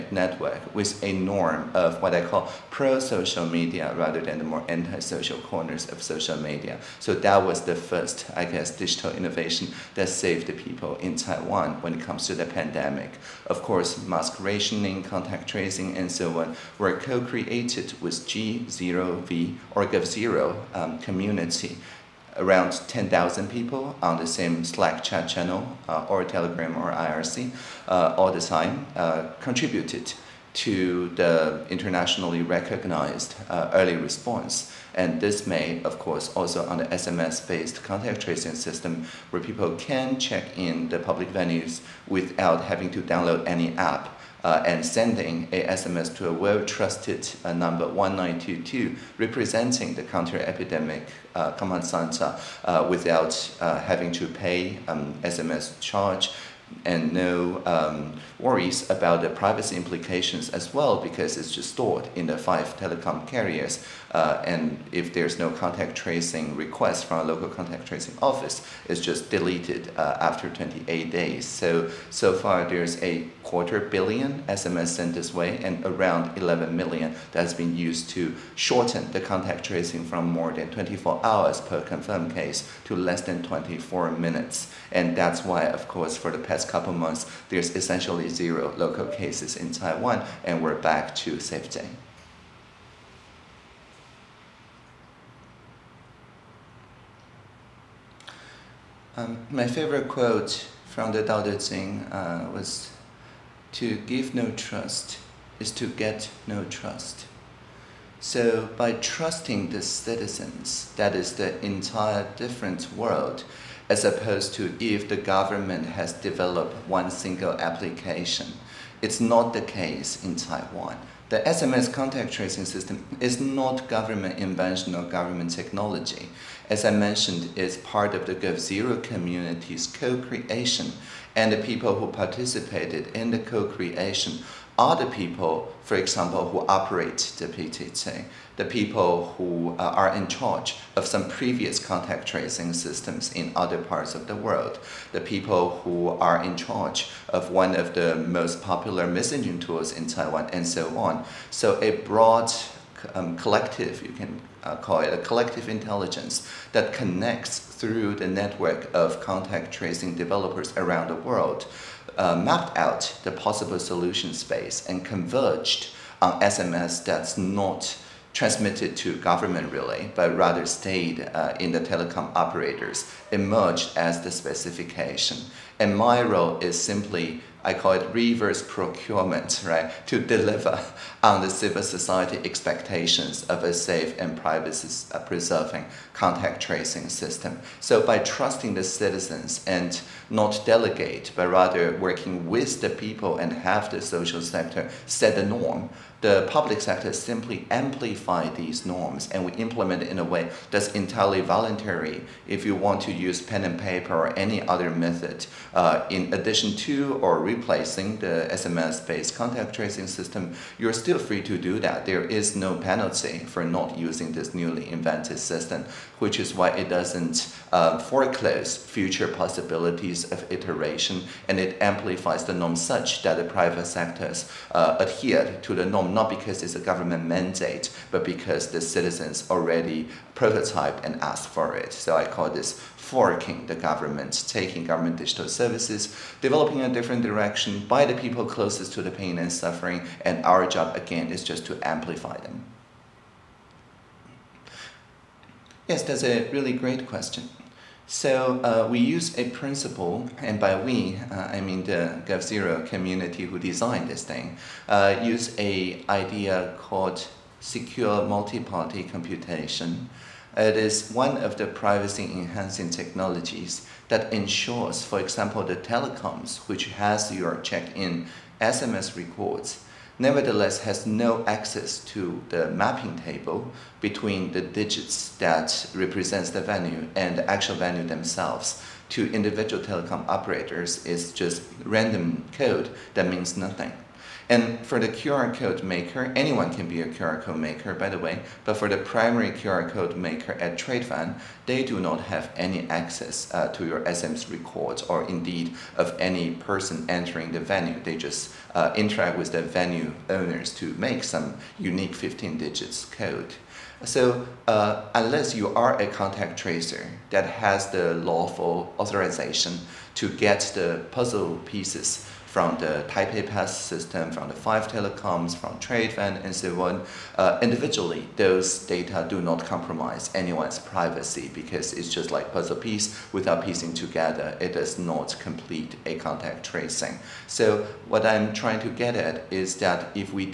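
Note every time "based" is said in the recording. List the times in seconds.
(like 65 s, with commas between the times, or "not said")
36 s, 208 s.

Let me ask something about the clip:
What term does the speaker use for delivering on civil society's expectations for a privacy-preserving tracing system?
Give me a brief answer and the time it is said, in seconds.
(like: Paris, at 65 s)
reverse procurement, at 178 s.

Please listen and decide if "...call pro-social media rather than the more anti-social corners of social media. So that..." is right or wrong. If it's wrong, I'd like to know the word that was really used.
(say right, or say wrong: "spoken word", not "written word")
right.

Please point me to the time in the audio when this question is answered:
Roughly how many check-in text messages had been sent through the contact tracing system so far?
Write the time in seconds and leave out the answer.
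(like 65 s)
73 s.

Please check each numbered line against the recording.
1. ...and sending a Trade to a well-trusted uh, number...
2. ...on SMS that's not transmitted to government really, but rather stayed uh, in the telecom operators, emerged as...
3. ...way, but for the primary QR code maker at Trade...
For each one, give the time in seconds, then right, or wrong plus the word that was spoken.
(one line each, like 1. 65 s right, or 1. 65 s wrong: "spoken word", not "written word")
1. 44 s wrong: "SMS", not "Trade"
2. 166 s right
3. 288 s right.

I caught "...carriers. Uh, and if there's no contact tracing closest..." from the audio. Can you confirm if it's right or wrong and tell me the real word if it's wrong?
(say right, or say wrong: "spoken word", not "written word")
wrong: "request", not "closest".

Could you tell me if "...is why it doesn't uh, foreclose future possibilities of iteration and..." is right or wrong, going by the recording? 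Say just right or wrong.
right.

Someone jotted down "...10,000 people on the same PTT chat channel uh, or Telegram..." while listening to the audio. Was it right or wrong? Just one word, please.
wrong.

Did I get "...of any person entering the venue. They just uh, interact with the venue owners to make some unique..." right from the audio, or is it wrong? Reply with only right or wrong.
right.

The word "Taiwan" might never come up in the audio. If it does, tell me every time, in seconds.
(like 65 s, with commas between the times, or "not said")
11 s, 89 s, 120 s, 150 s.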